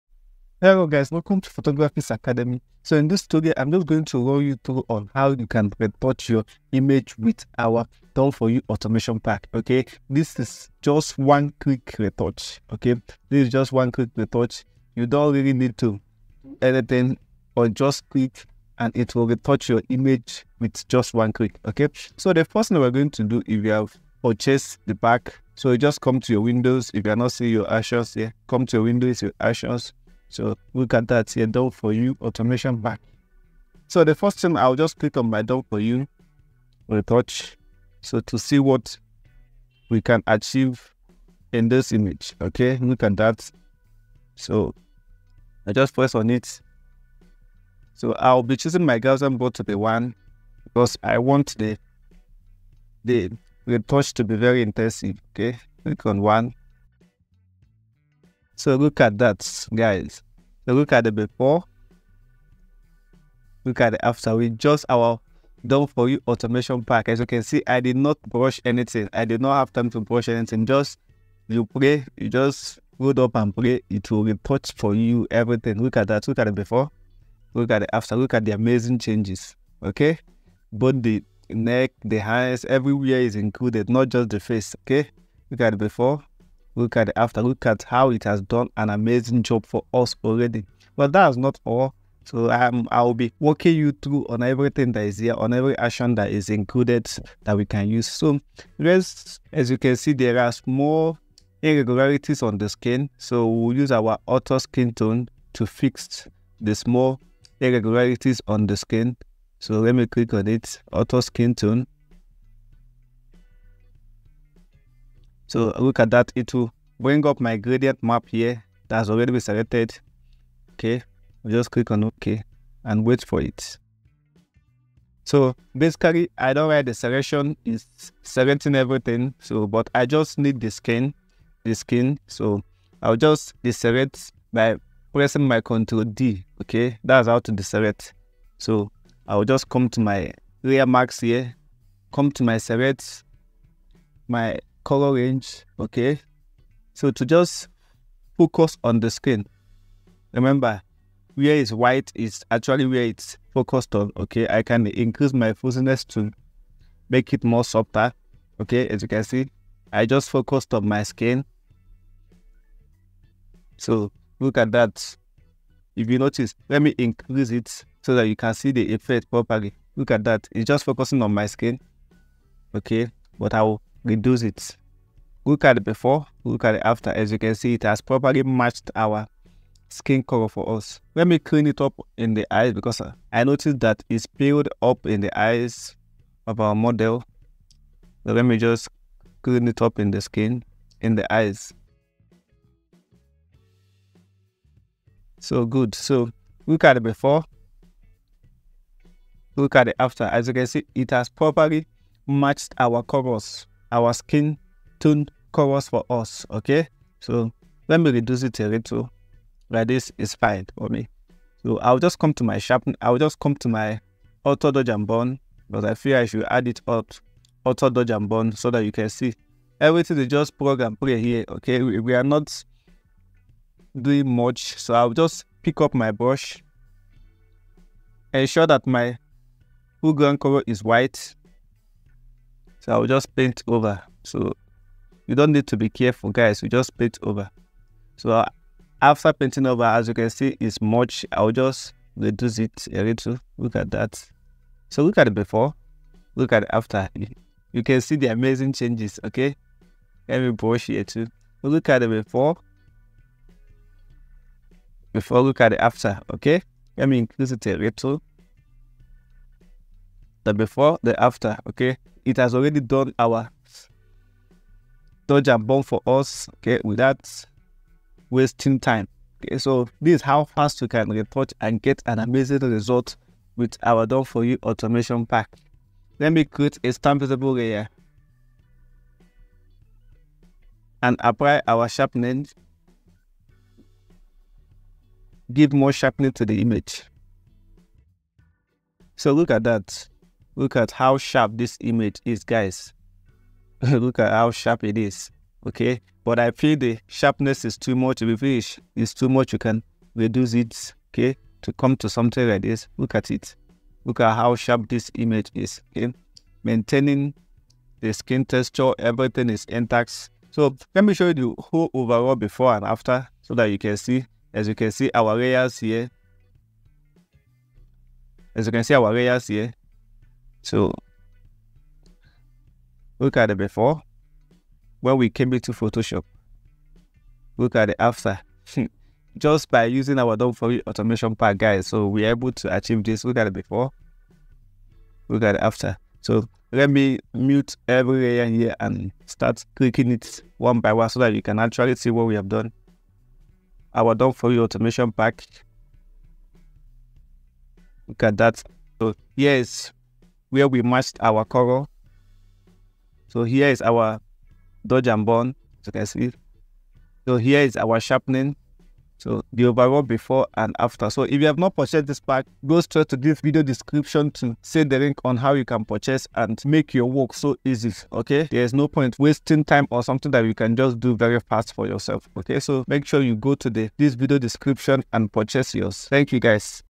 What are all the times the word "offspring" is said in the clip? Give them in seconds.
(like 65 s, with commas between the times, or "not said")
not said.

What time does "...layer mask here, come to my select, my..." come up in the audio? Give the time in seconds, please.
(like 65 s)
140 s.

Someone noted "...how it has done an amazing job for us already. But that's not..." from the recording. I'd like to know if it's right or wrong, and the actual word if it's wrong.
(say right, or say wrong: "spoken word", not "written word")
right.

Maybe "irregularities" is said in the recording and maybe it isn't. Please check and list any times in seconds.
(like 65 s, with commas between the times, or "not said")
101 s, 107 s.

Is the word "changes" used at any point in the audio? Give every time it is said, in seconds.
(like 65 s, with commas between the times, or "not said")
78 s, 248 s.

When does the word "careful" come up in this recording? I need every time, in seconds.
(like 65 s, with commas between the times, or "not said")
235 s.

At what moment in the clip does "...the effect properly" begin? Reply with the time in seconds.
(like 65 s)
168 s.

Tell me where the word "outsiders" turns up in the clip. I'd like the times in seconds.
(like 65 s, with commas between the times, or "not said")
not said.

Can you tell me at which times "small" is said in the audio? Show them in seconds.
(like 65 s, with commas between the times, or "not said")
100 s, 106 s.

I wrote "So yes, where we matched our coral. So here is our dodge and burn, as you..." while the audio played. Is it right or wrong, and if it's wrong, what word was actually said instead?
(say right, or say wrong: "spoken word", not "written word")
right.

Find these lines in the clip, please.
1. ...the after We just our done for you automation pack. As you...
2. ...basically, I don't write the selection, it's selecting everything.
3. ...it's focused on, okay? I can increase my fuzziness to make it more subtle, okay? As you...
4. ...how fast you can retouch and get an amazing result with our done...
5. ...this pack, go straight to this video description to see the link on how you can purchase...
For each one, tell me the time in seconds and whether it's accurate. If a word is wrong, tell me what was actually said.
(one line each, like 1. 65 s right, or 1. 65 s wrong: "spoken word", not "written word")
1. 63 s right
2. 125 s right
3. 153 s right
4. 270 s right
5. 362 s right.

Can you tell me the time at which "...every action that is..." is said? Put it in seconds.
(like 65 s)
95 s.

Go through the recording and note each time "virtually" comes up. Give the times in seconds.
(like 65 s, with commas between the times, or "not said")
not said.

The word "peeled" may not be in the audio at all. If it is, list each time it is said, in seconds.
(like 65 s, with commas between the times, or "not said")
184 s.